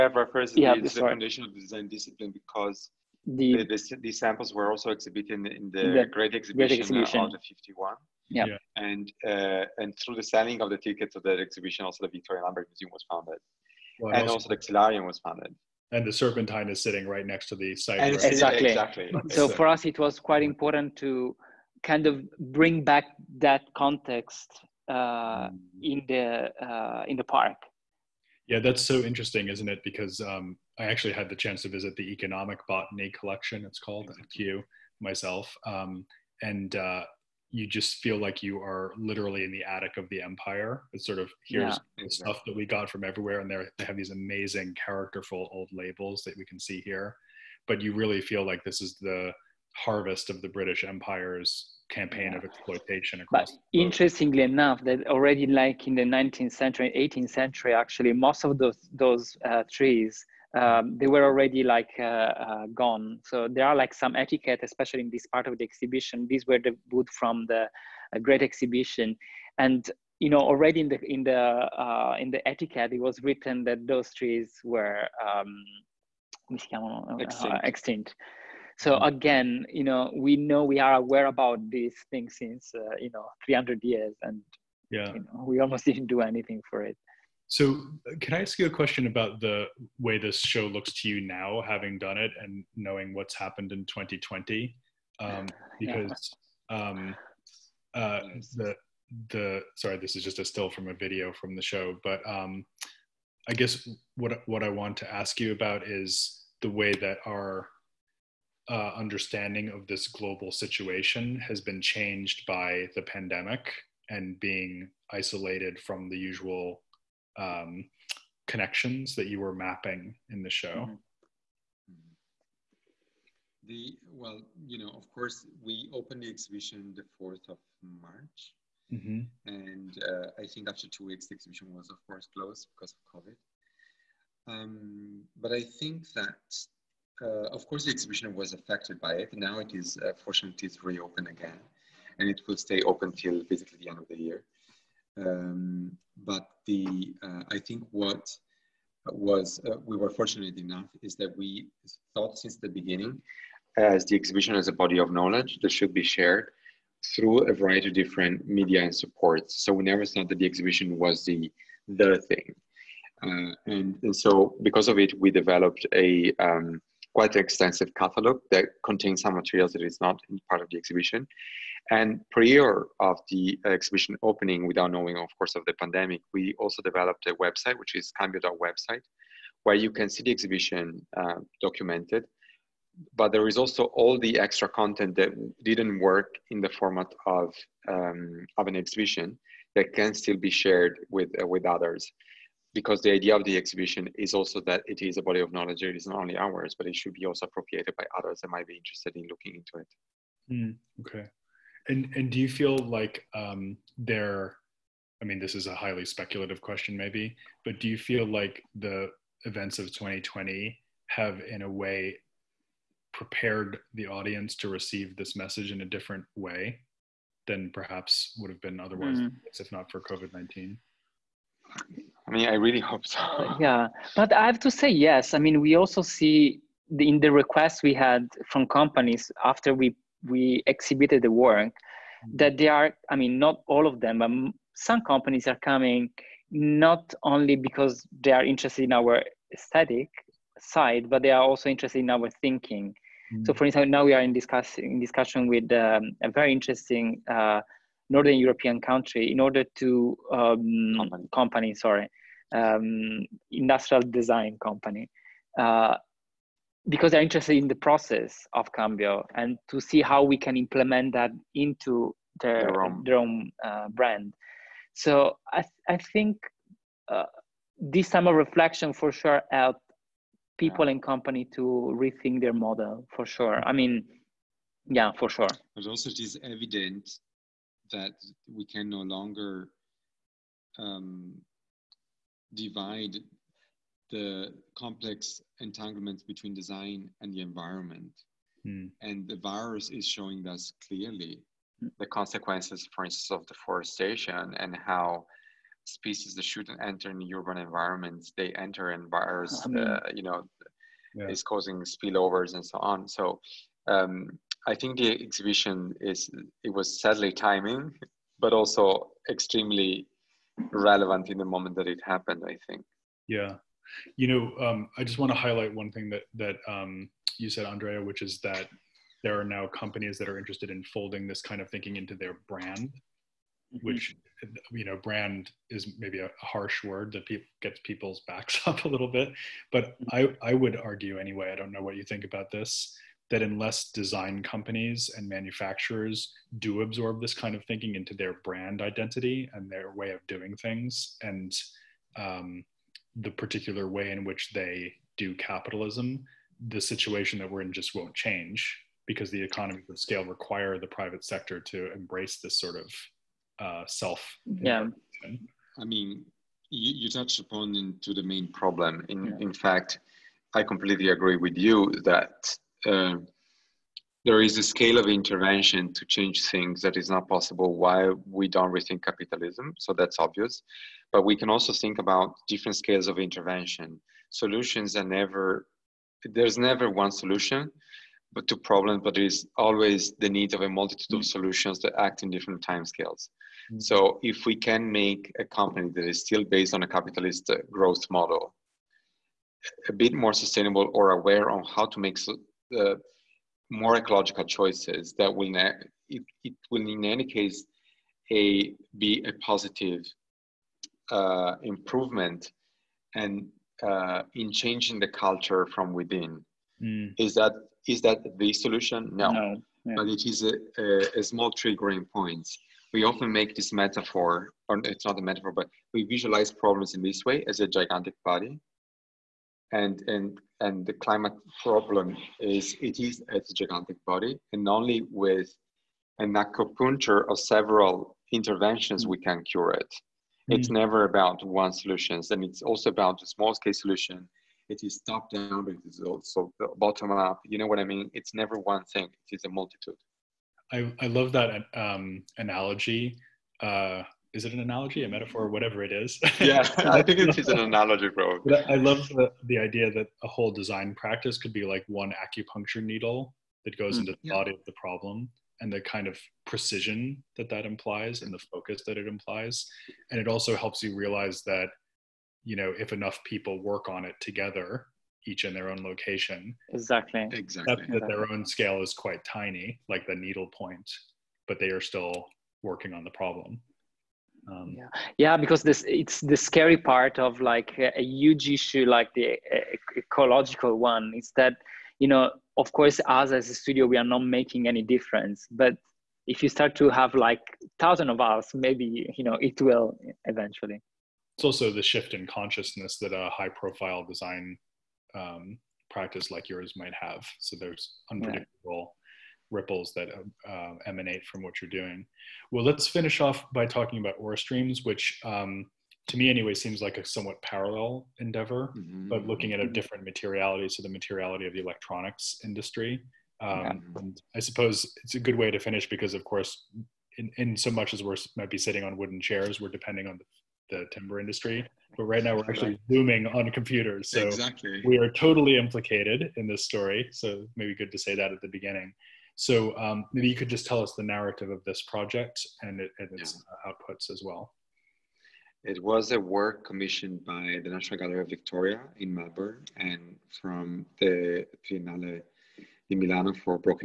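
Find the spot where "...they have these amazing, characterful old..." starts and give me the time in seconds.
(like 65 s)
43 s.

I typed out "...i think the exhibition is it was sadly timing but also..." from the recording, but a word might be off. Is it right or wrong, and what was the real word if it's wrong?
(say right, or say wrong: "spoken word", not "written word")
right.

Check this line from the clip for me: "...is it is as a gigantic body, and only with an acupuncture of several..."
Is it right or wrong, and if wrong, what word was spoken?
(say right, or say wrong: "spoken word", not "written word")
right.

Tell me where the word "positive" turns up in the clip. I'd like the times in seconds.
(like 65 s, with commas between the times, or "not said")
399 s.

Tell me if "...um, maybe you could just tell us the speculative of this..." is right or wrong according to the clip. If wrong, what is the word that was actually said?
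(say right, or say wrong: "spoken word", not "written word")
wrong: "narrative", not "speculative".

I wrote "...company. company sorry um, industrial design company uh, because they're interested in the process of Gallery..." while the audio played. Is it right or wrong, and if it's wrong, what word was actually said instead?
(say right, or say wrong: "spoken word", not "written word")
wrong: "Cambio", not "Gallery".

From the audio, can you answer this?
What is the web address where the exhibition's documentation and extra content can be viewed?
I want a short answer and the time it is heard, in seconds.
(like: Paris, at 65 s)
cambio.website, at 178 s.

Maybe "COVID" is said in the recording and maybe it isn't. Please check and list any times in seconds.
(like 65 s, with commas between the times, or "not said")
133 s, 220 s.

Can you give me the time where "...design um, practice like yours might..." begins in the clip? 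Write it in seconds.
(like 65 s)
494 s.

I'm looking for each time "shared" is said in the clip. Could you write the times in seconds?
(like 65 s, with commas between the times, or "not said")
156 s, 190 s.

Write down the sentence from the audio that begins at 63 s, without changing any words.
So there are like some etiquette, especially in this part of the exhibition.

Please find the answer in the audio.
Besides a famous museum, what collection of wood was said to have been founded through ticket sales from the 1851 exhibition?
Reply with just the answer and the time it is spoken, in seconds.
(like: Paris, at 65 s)
The Xylarium, at 14 s.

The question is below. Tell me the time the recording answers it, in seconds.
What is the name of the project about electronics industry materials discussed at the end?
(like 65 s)
504 s.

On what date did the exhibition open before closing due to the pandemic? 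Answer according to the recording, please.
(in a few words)
4 March.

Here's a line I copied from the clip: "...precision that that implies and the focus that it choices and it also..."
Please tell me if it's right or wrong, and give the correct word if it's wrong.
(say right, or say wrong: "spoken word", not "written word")
wrong: "implies", not "choices".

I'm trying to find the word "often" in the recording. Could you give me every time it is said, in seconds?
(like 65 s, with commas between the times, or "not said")
413 s.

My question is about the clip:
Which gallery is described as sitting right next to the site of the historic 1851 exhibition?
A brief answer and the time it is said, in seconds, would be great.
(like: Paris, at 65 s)
The Serpentine, at 16 s.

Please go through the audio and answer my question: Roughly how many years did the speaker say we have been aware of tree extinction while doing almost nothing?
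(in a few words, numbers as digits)
300 years.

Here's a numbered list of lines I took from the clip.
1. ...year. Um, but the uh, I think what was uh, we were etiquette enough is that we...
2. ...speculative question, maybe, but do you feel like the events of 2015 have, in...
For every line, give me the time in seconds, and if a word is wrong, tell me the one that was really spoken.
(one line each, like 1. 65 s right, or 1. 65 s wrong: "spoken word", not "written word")
1. 144 s wrong: "fortunate", not "etiquette"
2. 206 s wrong: "2020", not "2015".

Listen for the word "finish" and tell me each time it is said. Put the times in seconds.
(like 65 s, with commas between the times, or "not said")
502 s, 515 s.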